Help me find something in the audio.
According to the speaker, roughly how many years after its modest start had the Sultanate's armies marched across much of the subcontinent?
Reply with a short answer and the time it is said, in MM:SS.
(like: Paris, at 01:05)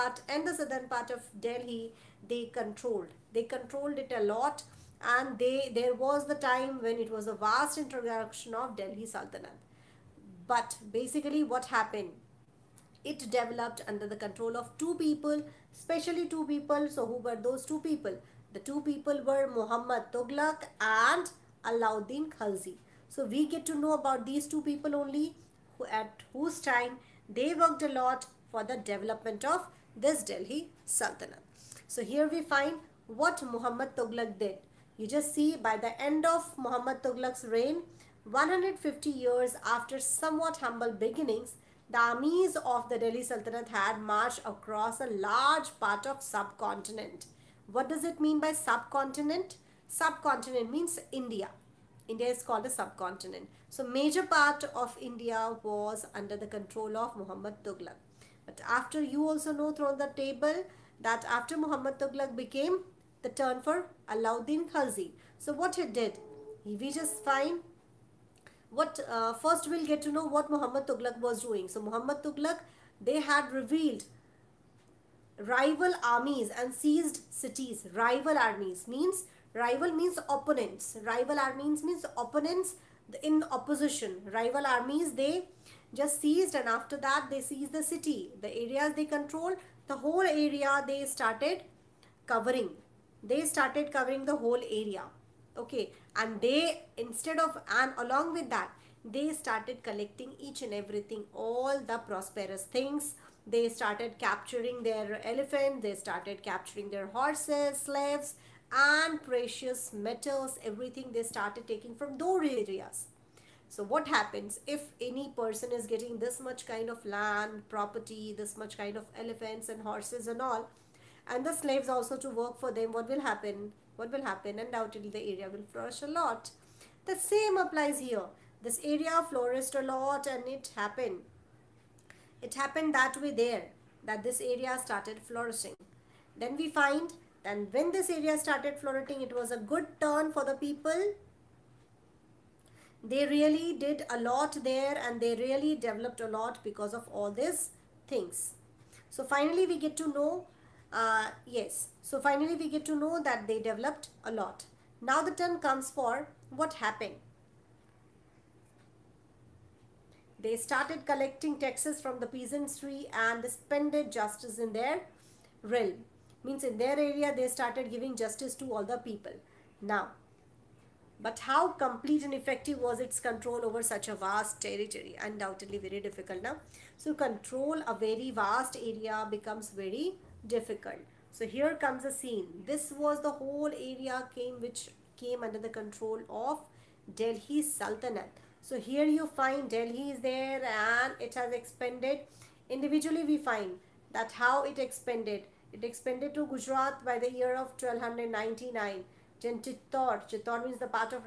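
150 years, at 00:38.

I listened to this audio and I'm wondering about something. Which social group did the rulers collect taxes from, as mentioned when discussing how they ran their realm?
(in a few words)
The peasantry.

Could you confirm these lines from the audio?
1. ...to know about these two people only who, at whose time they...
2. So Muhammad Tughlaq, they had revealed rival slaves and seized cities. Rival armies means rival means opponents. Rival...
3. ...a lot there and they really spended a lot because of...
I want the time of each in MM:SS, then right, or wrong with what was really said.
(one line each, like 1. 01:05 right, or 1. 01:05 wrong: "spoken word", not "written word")
1. 00:23 right
2. 01:11 wrong: "armies", not "slaves"
3. 02:24 wrong: "developed", not "spended".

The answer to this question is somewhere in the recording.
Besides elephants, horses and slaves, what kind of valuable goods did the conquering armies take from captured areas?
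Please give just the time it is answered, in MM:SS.
01:49.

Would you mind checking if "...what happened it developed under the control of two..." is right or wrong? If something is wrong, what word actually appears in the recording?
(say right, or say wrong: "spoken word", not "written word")
right.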